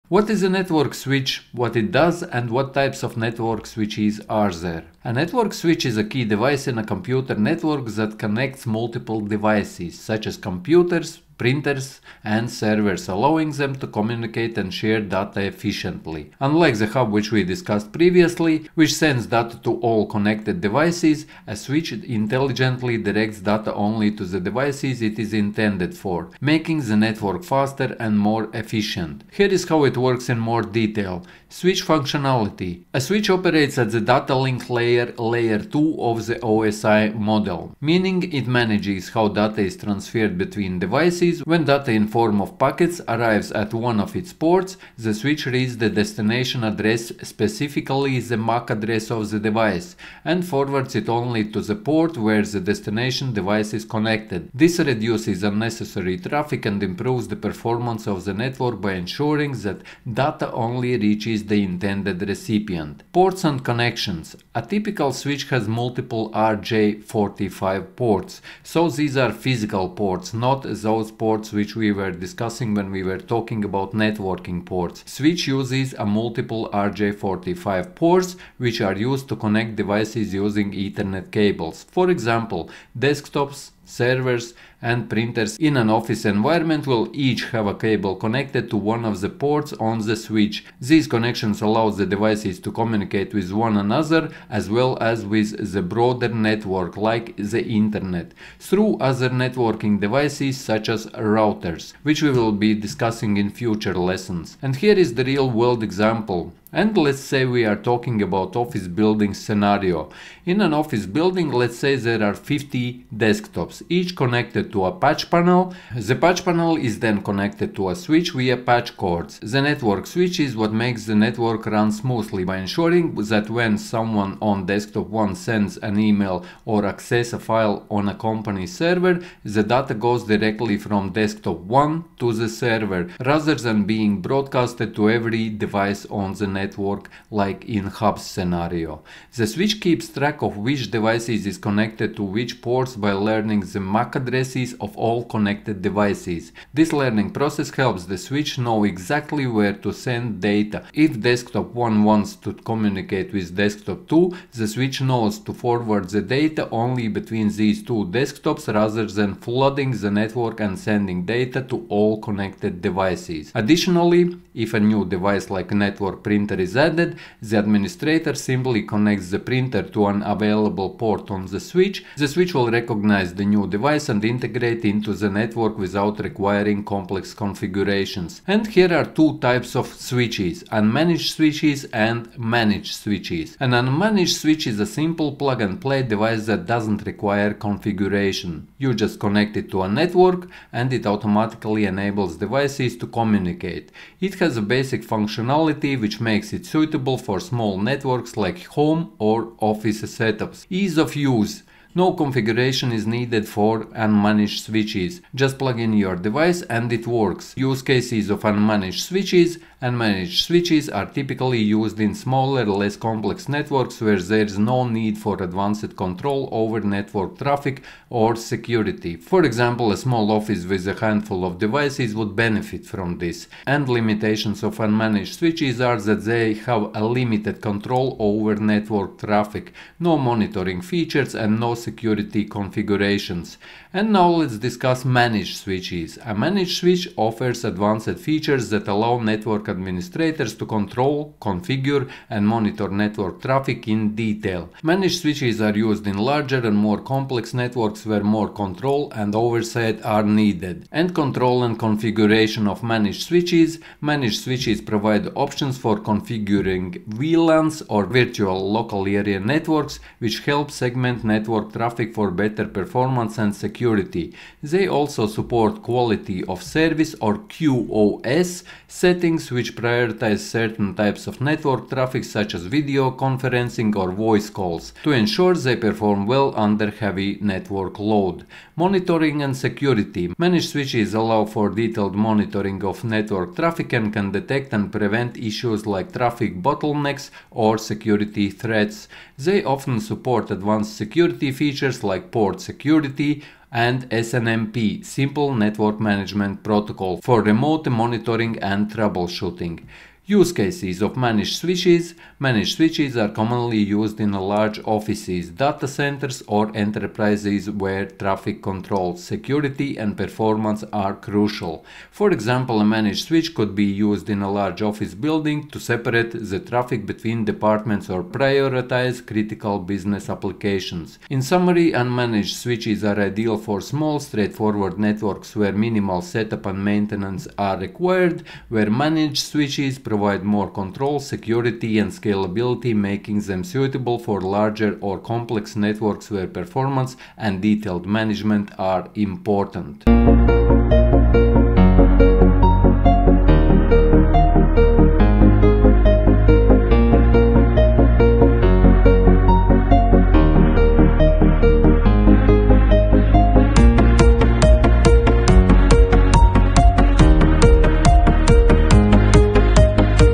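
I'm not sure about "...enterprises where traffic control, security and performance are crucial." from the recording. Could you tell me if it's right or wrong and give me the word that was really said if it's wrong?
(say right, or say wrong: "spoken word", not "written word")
right.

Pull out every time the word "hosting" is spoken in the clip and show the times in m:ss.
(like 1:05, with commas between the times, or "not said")
not said.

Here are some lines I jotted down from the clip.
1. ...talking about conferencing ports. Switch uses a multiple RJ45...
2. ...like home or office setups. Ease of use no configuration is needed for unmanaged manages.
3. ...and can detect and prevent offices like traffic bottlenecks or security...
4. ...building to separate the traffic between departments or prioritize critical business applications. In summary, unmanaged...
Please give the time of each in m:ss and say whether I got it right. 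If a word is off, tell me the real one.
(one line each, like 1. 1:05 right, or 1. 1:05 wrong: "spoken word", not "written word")
1. 1:13 wrong: "networking", not "conferencing"
2. 3:18 wrong: "switches", not "manages"
3. 4:43 wrong: "issues", not "offices"
4. 5:15 right.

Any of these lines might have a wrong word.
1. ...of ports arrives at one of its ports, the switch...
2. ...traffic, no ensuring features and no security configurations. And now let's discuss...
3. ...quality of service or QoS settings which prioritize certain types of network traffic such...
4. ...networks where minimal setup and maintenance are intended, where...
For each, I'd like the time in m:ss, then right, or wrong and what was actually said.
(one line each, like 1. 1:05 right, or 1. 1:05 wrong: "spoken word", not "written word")
1. 0:42 wrong: "packets", not "ports"
2. 3:49 wrong: "monitoring", not "ensuring"
3. 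4:25 right
4. 5:24 wrong: "required", not "intended".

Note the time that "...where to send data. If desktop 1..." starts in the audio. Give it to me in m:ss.
2:29.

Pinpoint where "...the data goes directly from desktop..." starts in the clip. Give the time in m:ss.
2:09.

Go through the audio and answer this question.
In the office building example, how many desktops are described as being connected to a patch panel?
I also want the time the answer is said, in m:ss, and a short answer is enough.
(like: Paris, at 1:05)
50, at 1:52.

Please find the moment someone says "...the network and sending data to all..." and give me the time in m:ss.
2:40.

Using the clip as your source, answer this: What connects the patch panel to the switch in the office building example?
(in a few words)
patch cords.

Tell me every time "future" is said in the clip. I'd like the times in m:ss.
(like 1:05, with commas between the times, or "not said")
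1:43.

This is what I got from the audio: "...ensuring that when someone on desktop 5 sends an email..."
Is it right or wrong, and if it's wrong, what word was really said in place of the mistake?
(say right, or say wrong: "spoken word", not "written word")
wrong: "1", not "5".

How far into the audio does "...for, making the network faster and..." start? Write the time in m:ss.
0:25.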